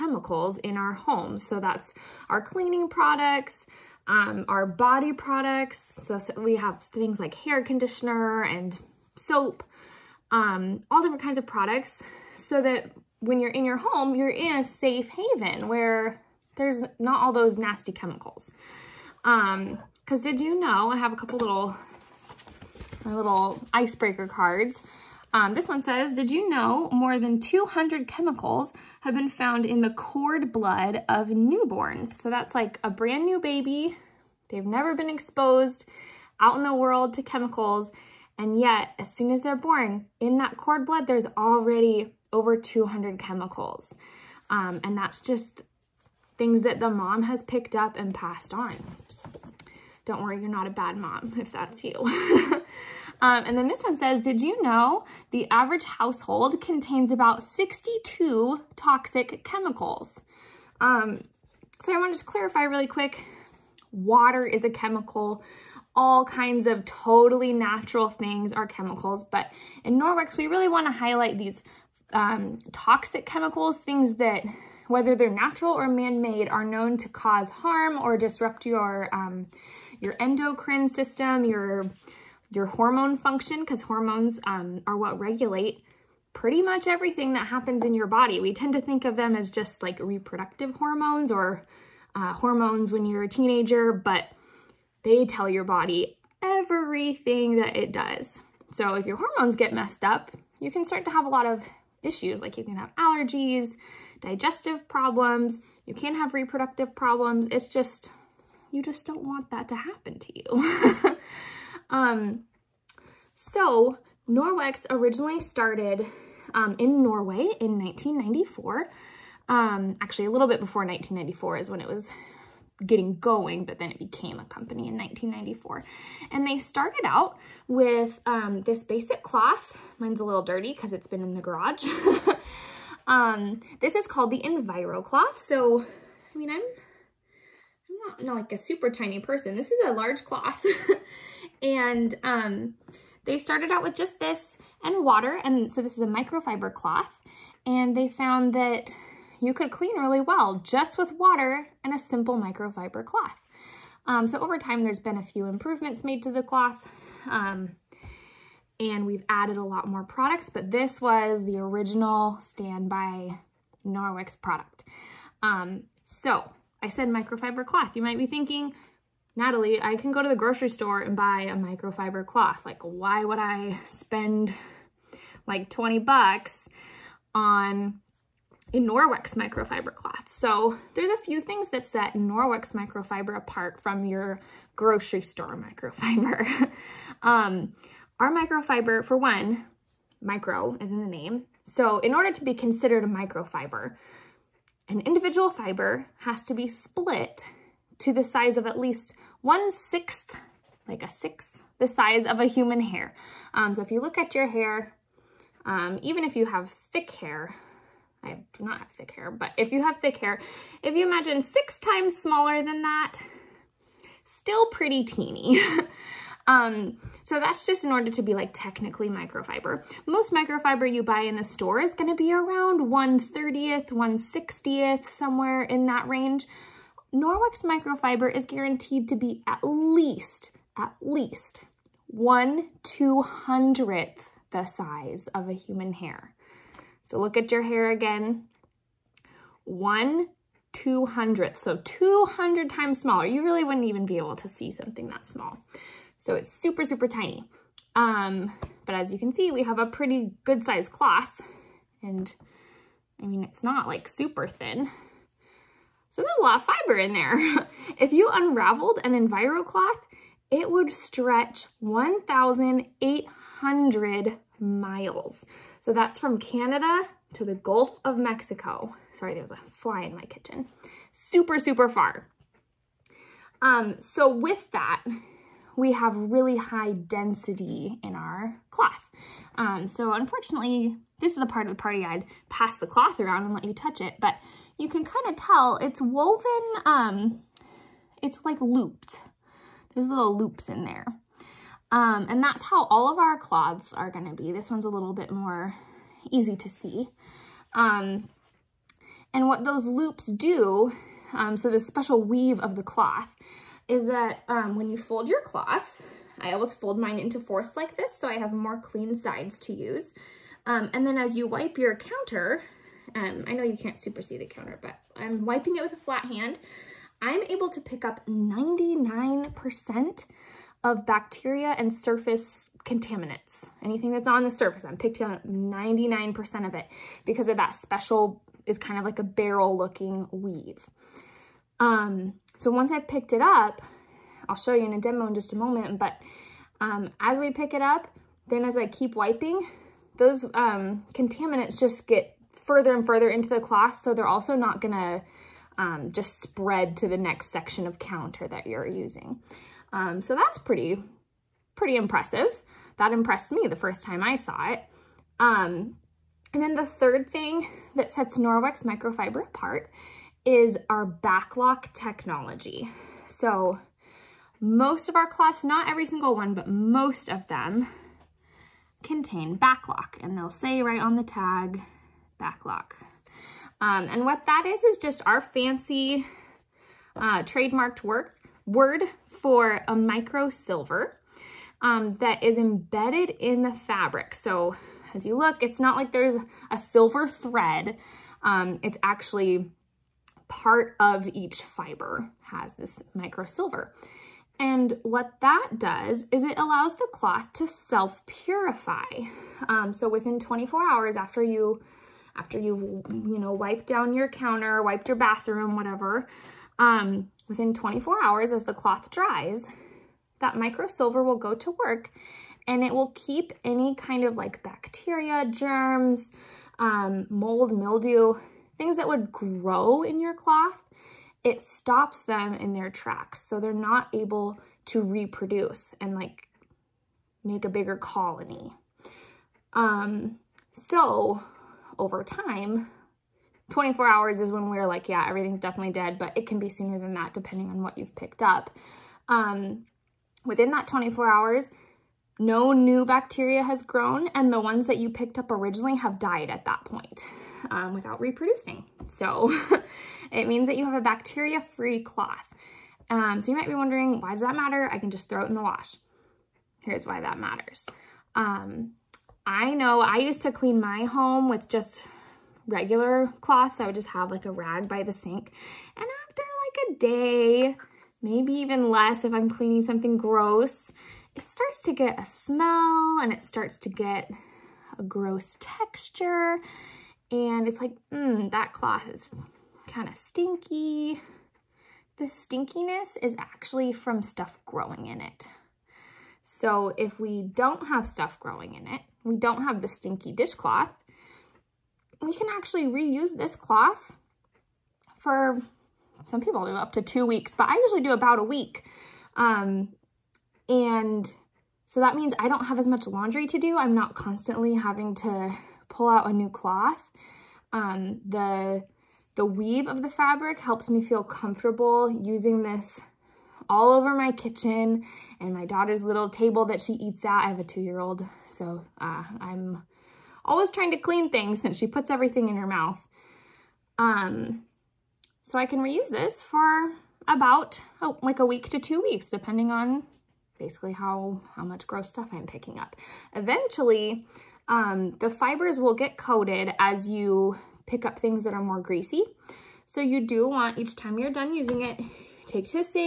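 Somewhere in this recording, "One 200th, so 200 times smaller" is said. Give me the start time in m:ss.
3:59.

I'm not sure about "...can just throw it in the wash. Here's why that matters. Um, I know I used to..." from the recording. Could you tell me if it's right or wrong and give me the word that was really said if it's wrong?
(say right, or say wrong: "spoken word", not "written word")
right.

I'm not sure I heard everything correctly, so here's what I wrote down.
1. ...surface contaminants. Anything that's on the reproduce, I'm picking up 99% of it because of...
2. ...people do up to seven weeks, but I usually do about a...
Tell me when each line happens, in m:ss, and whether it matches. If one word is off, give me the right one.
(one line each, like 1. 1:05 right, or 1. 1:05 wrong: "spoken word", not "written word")
1. 5:21 wrong: "surface", not "reproduce"
2. 8:16 wrong: "two", not "seven".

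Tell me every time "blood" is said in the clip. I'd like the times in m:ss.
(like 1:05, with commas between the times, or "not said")
0:30, 0:40.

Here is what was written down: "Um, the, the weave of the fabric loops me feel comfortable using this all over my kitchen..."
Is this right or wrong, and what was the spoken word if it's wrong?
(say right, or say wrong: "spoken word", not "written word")
wrong: "helps", not "loops".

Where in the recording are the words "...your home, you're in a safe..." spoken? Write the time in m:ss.
0:13.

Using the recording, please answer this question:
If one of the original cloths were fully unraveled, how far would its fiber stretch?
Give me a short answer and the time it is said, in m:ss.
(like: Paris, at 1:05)
1,800 miles, at 4:21.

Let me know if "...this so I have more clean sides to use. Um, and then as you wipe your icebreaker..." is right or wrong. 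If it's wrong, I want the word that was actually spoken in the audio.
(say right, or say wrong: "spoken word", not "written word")
wrong: "counter", not "icebreaker".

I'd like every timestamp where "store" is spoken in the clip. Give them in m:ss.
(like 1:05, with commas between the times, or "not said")
2:50, 3:05, 3:41.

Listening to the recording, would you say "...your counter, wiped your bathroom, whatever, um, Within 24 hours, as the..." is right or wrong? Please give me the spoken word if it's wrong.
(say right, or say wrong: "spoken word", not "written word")
right.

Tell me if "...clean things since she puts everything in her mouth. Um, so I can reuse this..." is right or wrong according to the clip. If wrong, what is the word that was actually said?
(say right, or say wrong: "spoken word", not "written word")
right.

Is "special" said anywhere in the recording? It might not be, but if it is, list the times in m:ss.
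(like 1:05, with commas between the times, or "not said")
5:01, 5:27.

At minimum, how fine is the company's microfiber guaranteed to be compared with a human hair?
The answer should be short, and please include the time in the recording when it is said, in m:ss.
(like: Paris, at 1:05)
1/200th, at 3:52.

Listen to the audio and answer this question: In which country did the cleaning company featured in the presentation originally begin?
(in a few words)
Norway.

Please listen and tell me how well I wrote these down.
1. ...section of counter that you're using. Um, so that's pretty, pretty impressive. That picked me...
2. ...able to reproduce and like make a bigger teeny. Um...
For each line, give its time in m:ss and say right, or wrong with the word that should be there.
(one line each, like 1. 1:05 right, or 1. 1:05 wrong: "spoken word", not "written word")
1. 5:47 wrong: "impressed", not "picked"
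2. 7:04 wrong: "colony", not "teeny".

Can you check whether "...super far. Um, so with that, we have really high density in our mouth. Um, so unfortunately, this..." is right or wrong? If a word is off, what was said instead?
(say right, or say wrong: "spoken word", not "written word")
wrong: "cloth", not "mouth".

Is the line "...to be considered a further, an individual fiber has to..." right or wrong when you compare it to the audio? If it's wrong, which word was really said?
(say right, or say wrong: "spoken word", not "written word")
wrong: "microfiber", not "further".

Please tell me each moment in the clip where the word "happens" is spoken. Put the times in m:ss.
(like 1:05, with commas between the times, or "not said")
1:27, 1:49.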